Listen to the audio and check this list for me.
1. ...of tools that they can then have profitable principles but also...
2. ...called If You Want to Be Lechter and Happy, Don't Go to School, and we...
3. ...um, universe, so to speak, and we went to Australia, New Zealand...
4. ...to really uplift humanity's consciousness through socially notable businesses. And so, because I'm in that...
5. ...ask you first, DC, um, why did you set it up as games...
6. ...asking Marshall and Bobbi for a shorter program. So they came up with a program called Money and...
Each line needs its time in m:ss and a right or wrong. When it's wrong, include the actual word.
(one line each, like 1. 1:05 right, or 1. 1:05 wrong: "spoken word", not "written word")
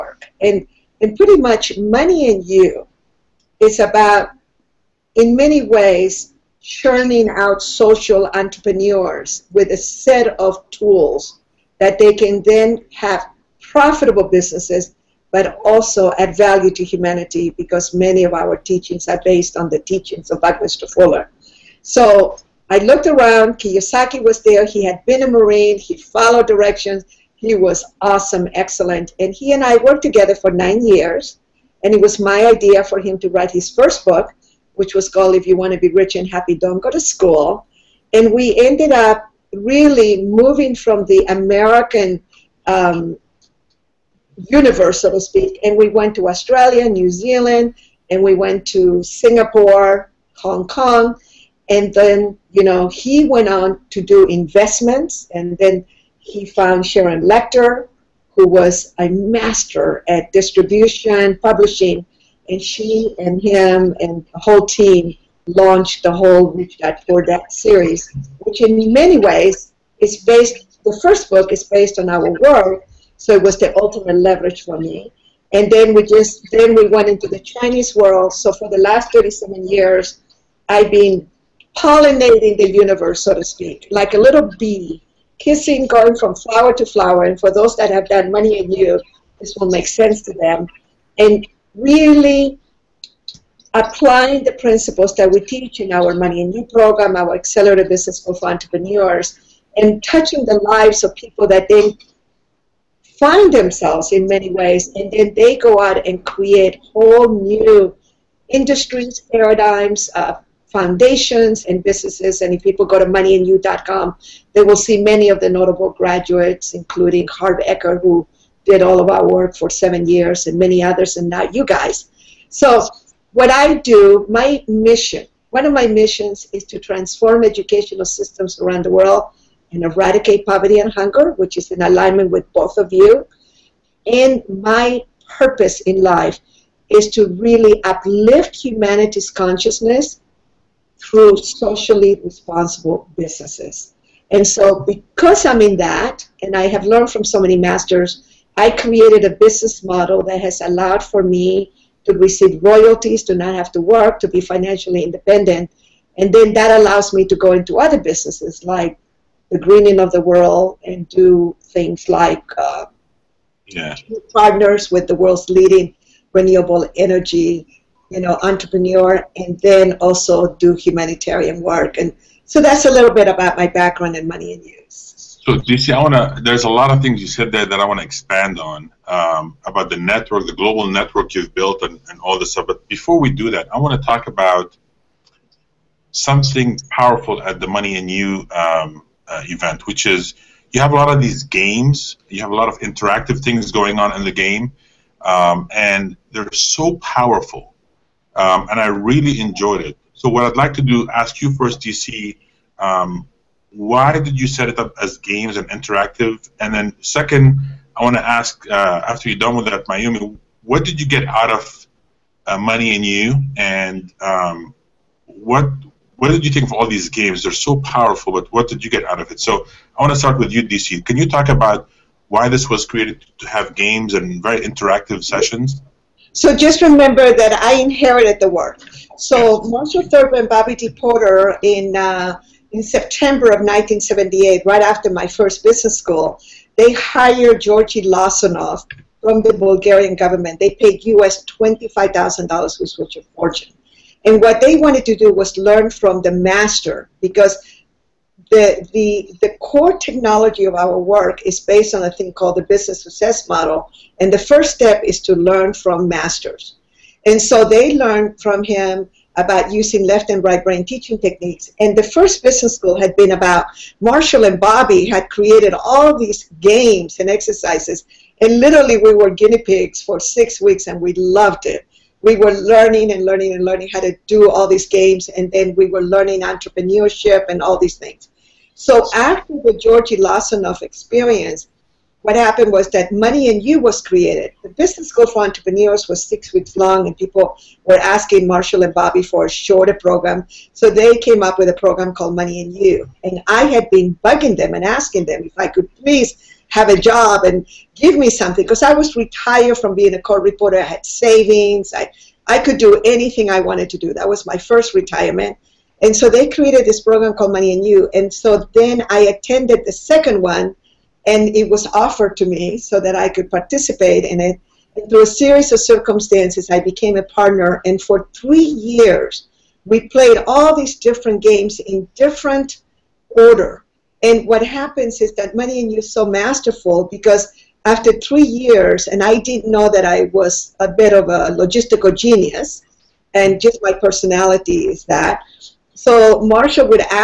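1. 0:10 wrong: "businesses", not "principles"
2. 0:35 wrong: "Rich", not "Lechter"
3. 0:42 right
4. 2:17 wrong: "responsible", not "notable"
5. 3:21 right
6. 4:47 right.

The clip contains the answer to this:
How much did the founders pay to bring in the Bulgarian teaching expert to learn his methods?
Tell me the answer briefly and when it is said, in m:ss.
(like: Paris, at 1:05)
$25,000, at 4:01.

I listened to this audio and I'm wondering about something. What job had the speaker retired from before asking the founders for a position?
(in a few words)
Court reporter.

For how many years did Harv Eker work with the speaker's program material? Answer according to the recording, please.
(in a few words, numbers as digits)
7.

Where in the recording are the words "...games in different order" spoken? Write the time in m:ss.
5:21.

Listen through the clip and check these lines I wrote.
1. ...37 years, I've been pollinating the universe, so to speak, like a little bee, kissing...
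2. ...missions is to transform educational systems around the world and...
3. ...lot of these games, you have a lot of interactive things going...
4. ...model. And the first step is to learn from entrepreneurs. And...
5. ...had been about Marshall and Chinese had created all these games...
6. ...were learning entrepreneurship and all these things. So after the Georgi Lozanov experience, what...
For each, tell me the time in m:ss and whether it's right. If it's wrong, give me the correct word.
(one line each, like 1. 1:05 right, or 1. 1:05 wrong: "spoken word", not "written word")
1. 1:19 right
2. 2:05 right
3. 3:10 right
4. 4:13 wrong: "masters", not "entrepreneurs"
5. 4:23 wrong: "Bobbi", not "Chinese"
6. 4:35 right.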